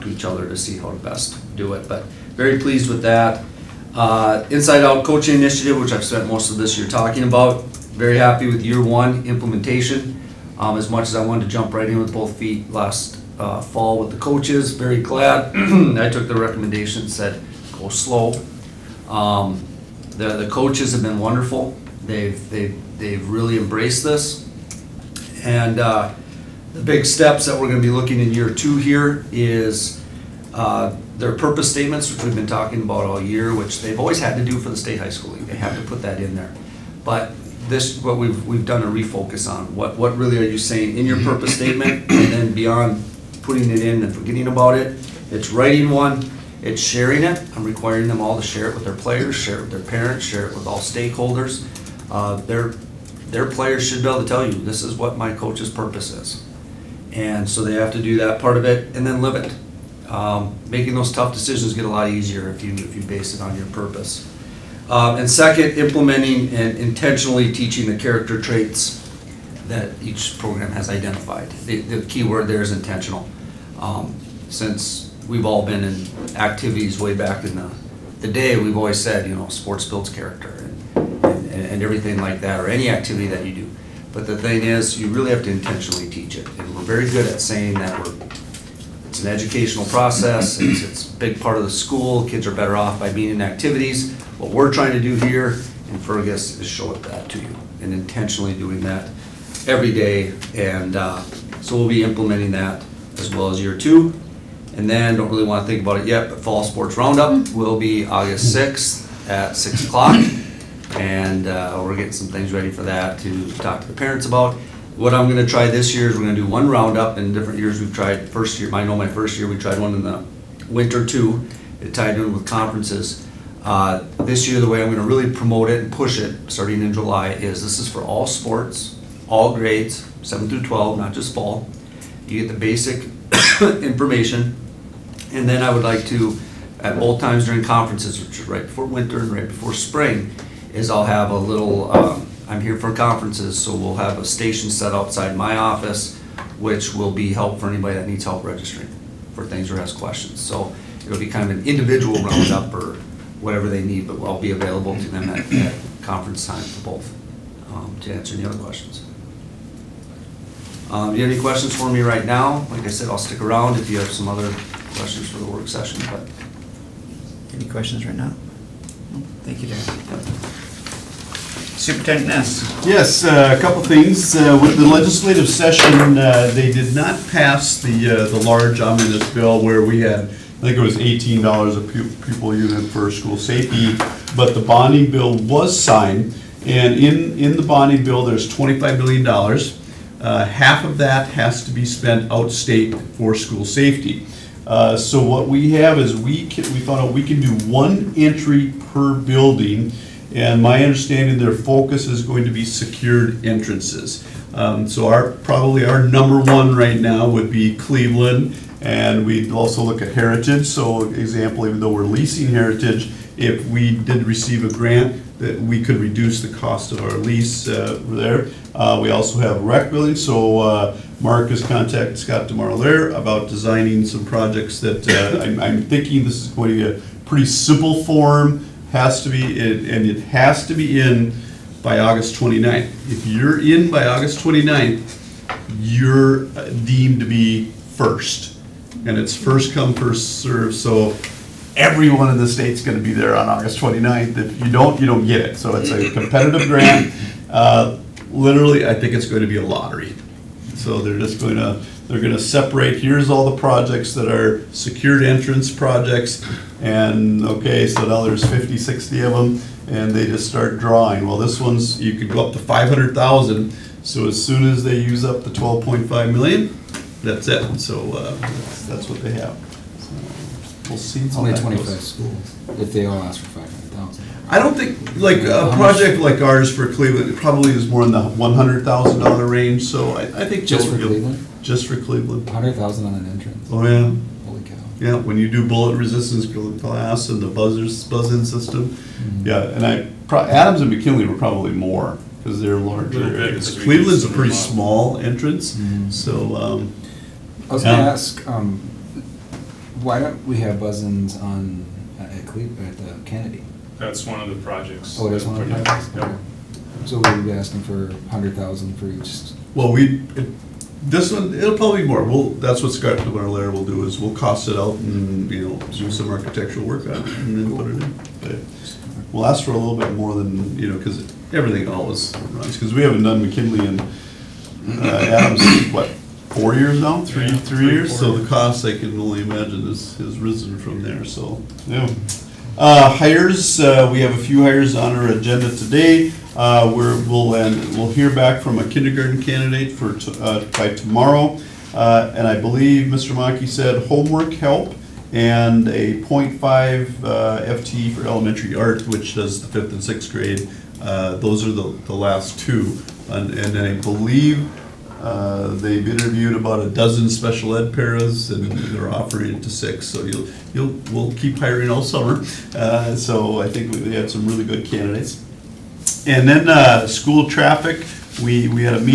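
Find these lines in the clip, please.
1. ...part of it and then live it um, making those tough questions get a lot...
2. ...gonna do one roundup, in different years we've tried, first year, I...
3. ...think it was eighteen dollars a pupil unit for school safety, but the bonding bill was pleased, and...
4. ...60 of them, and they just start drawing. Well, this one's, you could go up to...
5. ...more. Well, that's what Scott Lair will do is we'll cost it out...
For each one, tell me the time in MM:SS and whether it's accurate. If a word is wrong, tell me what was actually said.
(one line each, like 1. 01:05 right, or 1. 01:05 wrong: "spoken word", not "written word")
1. 00:58 wrong: "decisions", not "questions"
2. 01:56 right
3. 03:00 wrong: "signed", not "pleased"
4. 04:18 right
5. 05:12 right.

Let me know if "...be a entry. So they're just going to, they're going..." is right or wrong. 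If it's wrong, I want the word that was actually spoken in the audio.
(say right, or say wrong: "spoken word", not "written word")
wrong: "lottery", not "entry".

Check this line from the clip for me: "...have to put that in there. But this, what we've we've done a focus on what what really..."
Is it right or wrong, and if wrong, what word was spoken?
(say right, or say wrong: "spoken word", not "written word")
wrong: "refocus", not "focus".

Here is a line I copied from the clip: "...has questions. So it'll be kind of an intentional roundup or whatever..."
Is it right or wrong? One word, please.
wrong.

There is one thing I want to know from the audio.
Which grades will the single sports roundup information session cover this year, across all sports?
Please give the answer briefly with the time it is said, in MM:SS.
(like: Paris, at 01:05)
7 through 12, at 02:10.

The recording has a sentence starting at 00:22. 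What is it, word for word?
They've, they've, they've really embraced this.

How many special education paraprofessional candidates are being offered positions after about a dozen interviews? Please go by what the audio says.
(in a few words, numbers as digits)
6.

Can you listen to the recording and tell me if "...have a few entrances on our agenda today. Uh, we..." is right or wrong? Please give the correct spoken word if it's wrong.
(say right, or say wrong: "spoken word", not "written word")
wrong: "hires", not "entrances".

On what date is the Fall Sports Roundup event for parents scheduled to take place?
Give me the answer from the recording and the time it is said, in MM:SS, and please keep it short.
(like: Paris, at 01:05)
August 6, at 01:48.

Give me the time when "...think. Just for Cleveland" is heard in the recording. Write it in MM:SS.
04:40.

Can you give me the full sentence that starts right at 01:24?
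But the thing is, you really have to intentionally teach it.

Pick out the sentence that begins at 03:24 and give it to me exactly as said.
Um, so our, probably our number one right now would be Cleveland, and we'd also look at Heritage.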